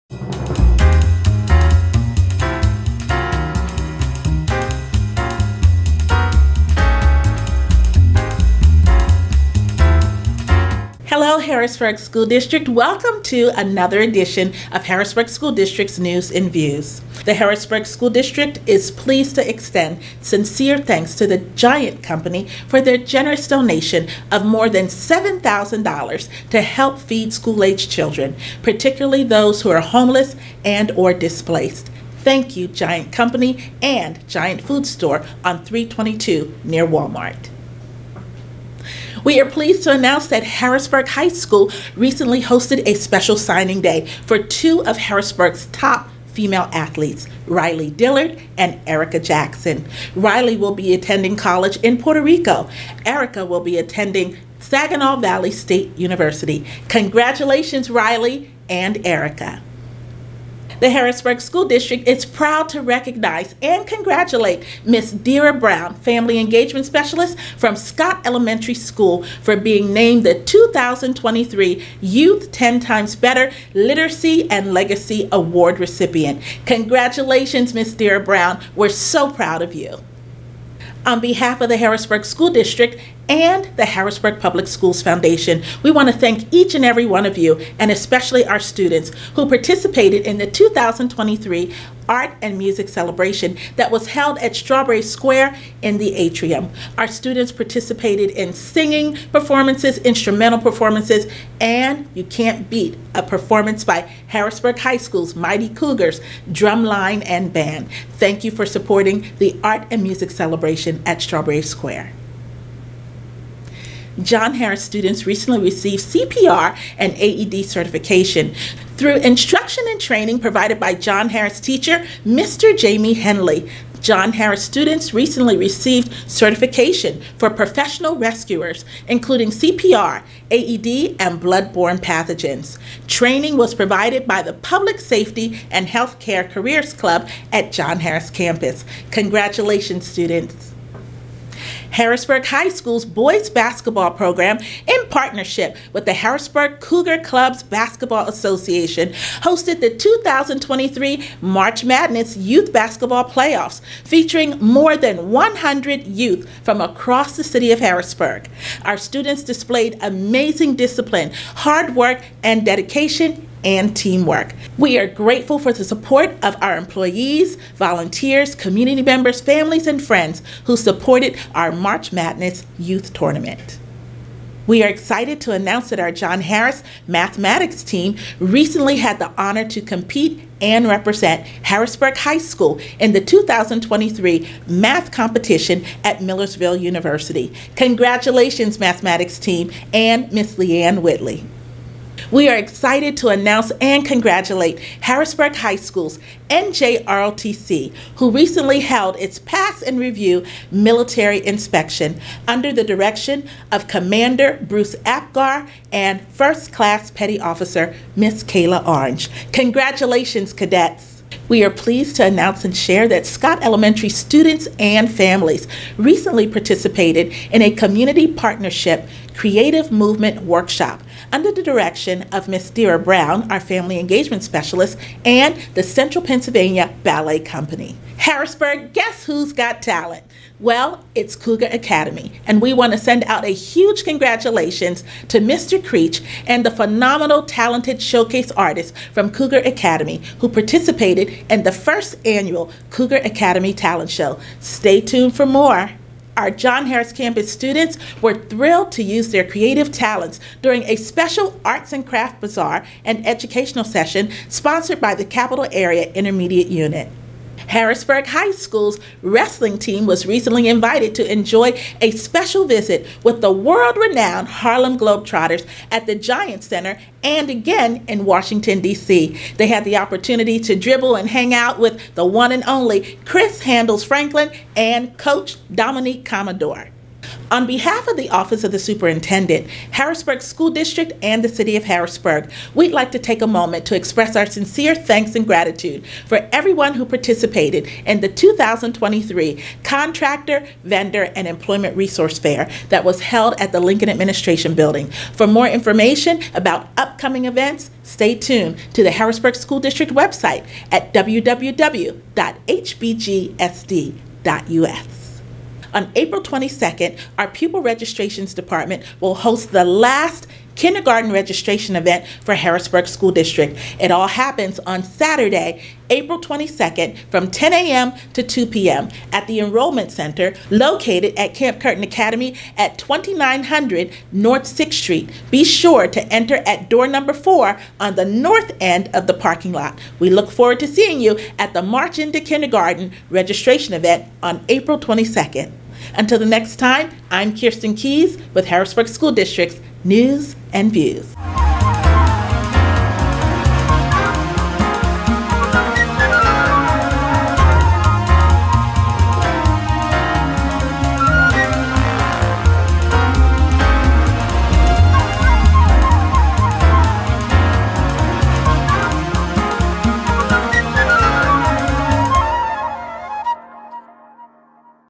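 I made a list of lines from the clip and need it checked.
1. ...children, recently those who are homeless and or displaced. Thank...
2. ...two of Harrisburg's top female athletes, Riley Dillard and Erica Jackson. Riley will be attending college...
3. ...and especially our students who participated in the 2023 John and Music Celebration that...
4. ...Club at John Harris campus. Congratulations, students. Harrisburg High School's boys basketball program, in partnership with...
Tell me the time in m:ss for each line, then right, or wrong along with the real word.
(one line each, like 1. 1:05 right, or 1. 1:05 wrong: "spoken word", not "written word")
1. 0:27 wrong: "particularly", not "recently"
2. 0:44 right
3. 1:27 wrong: "Art", not "John"
4. 2:16 right.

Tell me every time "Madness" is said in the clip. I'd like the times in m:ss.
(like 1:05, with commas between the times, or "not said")
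2:31, 2:52.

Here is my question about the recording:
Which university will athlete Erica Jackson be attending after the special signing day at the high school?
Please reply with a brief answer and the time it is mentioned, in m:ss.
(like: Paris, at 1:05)
Saginaw Valley State University, at 0:54.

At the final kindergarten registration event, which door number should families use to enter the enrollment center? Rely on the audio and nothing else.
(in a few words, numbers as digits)
4.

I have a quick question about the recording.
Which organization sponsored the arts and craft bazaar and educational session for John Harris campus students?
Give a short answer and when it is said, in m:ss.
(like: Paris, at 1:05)
Capital Area Intermediate Unit, at 4:15.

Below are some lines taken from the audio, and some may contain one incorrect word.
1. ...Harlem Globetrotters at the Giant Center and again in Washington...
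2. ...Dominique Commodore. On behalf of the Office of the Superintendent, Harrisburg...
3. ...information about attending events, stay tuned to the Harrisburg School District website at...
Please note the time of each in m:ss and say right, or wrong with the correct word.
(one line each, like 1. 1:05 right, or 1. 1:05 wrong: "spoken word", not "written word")
1. 4:24 right
2. 4:35 right
3. 4:55 wrong: "upcoming", not "attending".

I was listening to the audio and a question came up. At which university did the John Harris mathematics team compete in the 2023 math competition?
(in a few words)
Millersville University.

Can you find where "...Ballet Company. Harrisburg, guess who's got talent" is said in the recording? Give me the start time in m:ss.
3:47.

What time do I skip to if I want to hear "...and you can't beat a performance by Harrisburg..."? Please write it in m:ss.
1:41.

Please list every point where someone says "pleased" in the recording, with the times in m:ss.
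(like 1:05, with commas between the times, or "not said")
0:18, 0:39, 3:31.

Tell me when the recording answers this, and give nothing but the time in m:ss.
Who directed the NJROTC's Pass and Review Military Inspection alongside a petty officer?
3:23.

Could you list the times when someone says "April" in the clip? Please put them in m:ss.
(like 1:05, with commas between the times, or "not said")
5:06, 5:16, 5:34.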